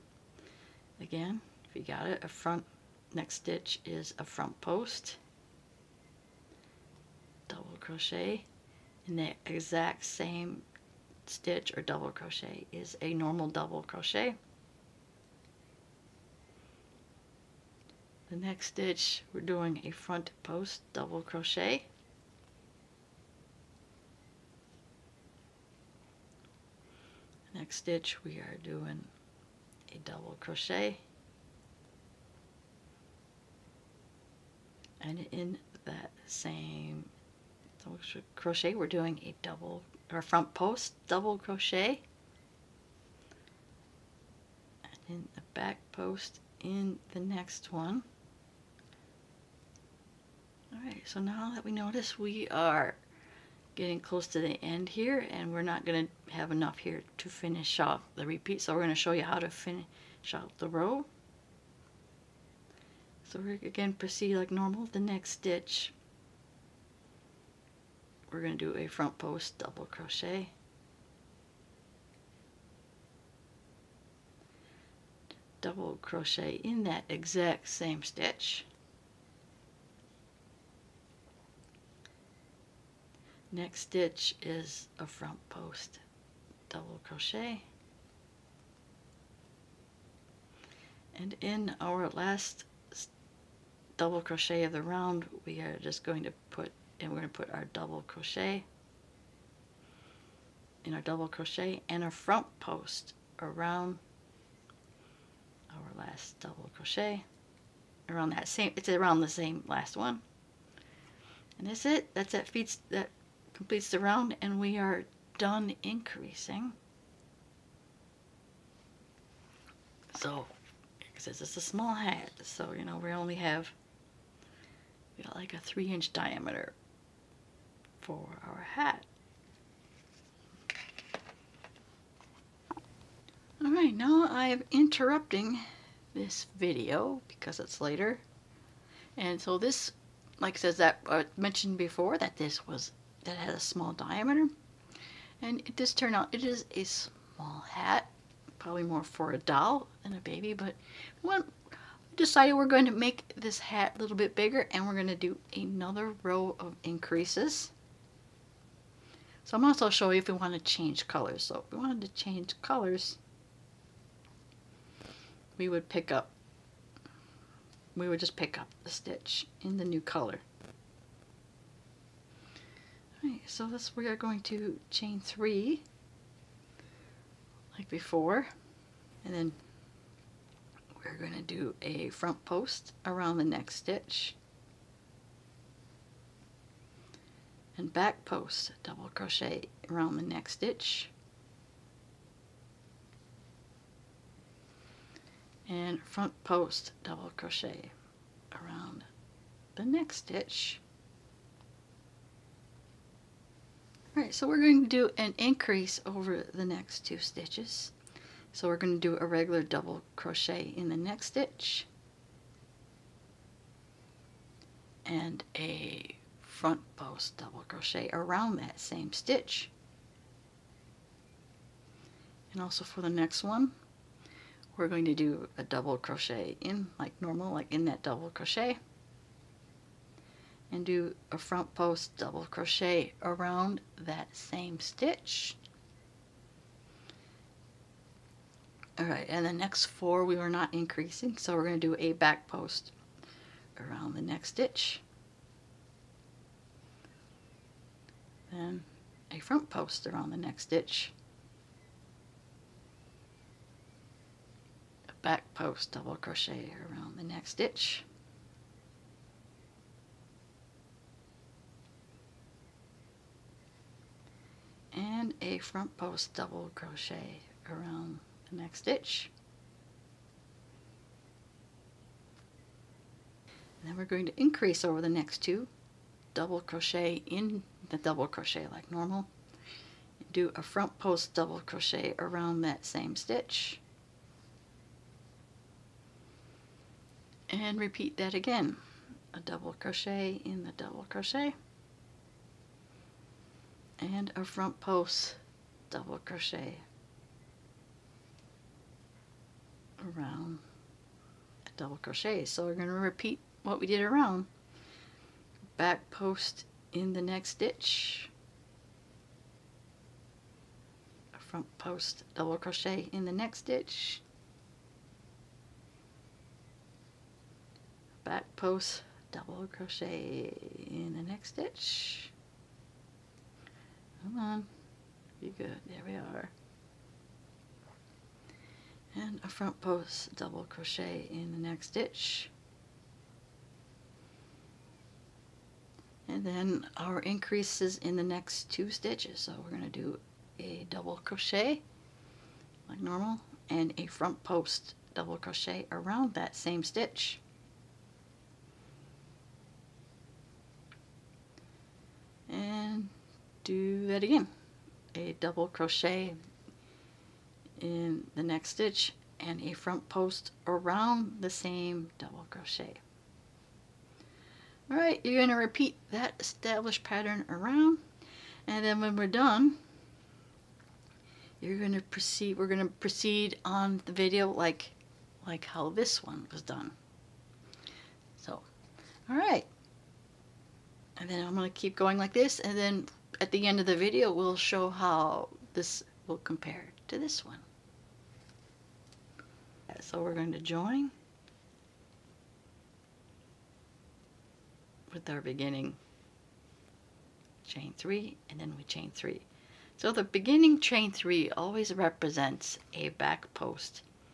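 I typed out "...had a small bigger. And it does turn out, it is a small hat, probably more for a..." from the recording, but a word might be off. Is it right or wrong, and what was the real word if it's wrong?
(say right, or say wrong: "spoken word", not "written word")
wrong: "diameter", not "bigger".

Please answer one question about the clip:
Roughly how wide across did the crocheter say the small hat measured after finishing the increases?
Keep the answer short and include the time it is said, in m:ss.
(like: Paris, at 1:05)
3 inches, at 2:05.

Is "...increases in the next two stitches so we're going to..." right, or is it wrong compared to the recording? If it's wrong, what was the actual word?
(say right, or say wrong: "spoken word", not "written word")
right.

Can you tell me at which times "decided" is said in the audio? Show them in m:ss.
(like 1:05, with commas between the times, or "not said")
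2:32.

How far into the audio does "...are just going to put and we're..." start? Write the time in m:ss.
1:35.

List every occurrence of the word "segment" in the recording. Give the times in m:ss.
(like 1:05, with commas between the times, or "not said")
not said.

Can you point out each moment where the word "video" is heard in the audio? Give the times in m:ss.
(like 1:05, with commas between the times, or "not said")
2:16, 6:14, 6:23.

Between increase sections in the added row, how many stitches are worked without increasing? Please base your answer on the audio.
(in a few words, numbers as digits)
4.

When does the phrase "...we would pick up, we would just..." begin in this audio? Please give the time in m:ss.
2:45.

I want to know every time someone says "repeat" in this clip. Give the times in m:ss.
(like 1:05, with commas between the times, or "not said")
0:58, 4:47, 5:02, 6:05.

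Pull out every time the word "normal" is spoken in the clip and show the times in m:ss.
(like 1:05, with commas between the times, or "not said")
0:13, 1:04, 3:47, 4:38, 5:43.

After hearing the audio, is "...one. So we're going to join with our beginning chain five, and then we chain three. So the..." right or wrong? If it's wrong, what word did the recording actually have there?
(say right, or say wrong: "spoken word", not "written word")
wrong: "three", not "five".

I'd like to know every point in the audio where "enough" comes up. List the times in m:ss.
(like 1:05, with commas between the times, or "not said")
0:56.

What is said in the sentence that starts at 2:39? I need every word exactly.
So I'm also show you if we want to change colors.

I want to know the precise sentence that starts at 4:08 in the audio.
Then a front post around the next stitch.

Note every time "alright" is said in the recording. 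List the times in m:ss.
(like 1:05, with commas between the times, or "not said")
2:53, 3:24, 6:04, 6:19.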